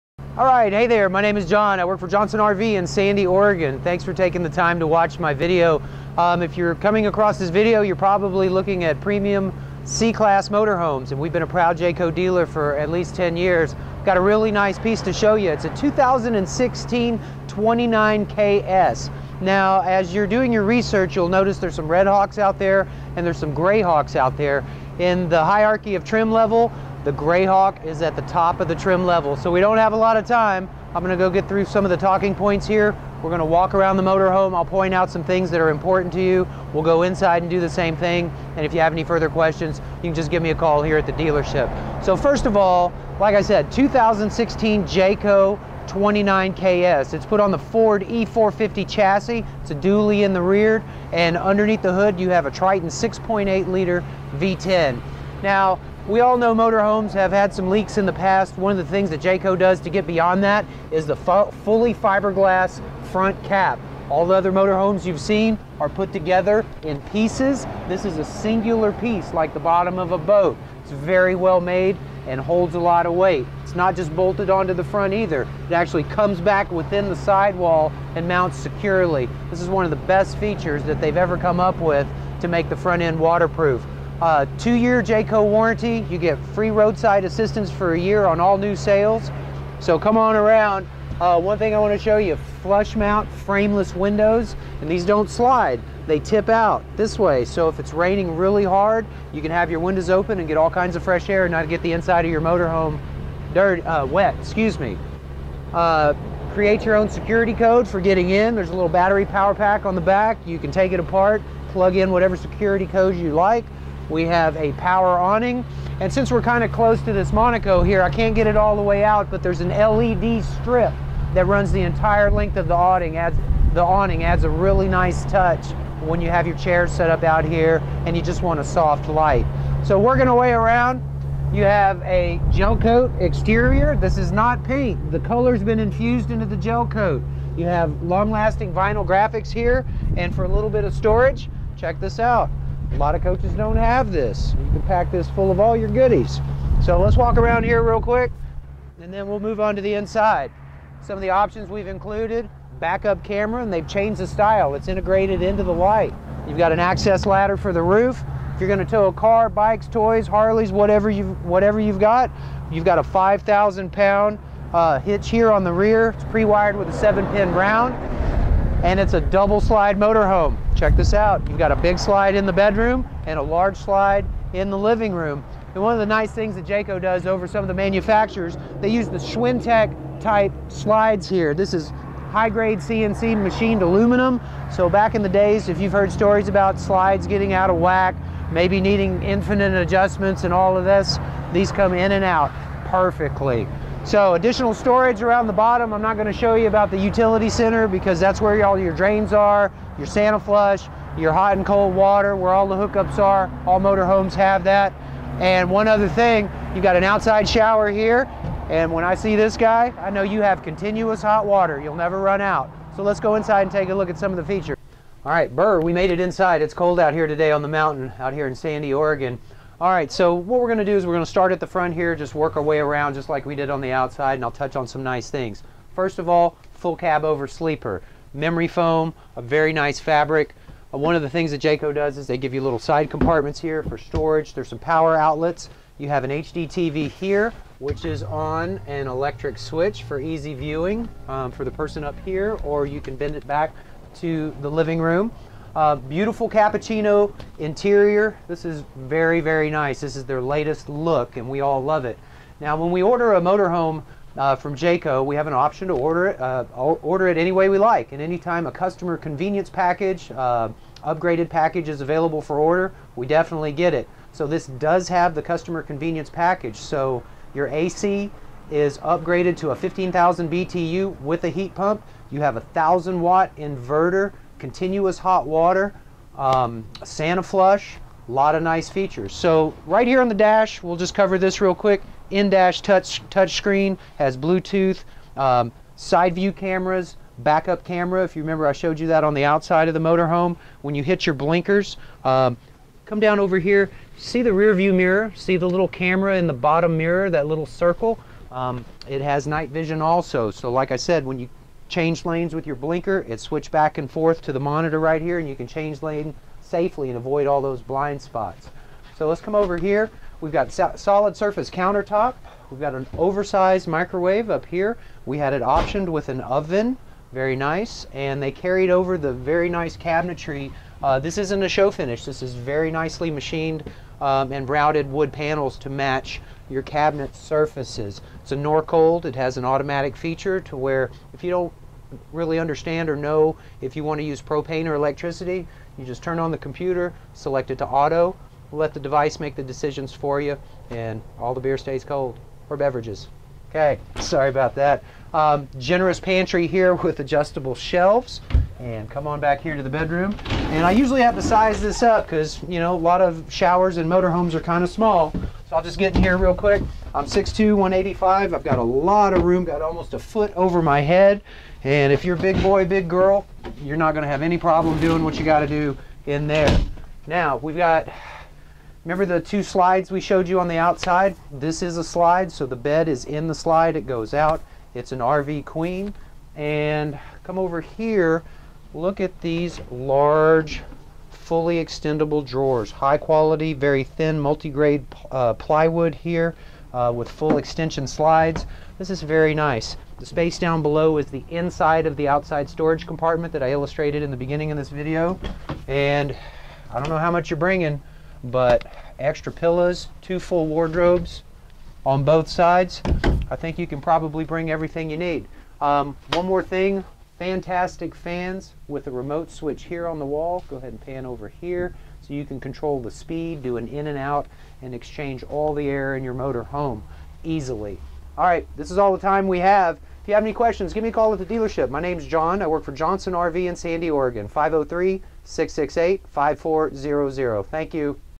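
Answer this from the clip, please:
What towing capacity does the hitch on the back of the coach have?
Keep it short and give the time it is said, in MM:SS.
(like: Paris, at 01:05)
5,000 pounds, at 02:43.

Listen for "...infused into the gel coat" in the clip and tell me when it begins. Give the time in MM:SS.
02:15.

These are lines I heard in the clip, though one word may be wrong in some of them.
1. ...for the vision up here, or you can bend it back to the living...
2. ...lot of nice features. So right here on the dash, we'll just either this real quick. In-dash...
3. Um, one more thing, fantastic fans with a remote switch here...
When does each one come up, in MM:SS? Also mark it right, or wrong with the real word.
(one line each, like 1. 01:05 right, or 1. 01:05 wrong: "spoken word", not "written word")
1. 04:01 wrong: "person", not "vision"
2. 04:38 wrong: "cover", not "either"
3. 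06:45 right.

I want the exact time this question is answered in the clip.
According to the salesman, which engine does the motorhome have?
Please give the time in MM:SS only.
00:52.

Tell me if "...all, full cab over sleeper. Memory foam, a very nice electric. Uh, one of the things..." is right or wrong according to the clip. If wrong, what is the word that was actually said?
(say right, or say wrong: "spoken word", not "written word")
wrong: "fabric", not "electric".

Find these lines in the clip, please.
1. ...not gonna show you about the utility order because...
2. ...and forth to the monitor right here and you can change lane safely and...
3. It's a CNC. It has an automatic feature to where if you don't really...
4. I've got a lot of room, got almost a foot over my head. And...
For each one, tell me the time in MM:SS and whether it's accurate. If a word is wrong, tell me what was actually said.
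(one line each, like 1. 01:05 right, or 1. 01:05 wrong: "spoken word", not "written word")
1. 03:16 wrong: "center", not "order"
2. 05:03 right
3. 05:28 wrong: "Norcold", not "CNC"
4. 05:58 right.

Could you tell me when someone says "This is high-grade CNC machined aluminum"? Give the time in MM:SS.
03:01.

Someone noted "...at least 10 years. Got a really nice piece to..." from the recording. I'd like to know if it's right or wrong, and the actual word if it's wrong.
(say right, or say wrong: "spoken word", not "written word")
right.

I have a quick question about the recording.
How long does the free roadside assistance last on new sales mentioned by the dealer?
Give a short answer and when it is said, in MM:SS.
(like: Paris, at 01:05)
a year, at 01:27.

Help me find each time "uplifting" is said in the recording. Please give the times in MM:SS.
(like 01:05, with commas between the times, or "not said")
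not said.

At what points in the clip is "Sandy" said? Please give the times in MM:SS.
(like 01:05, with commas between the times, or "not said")
00:02, 03:38, 07:03.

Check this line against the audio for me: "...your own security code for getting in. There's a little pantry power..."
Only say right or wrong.
wrong.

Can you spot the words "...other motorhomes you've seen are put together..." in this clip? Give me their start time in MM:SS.
01:04.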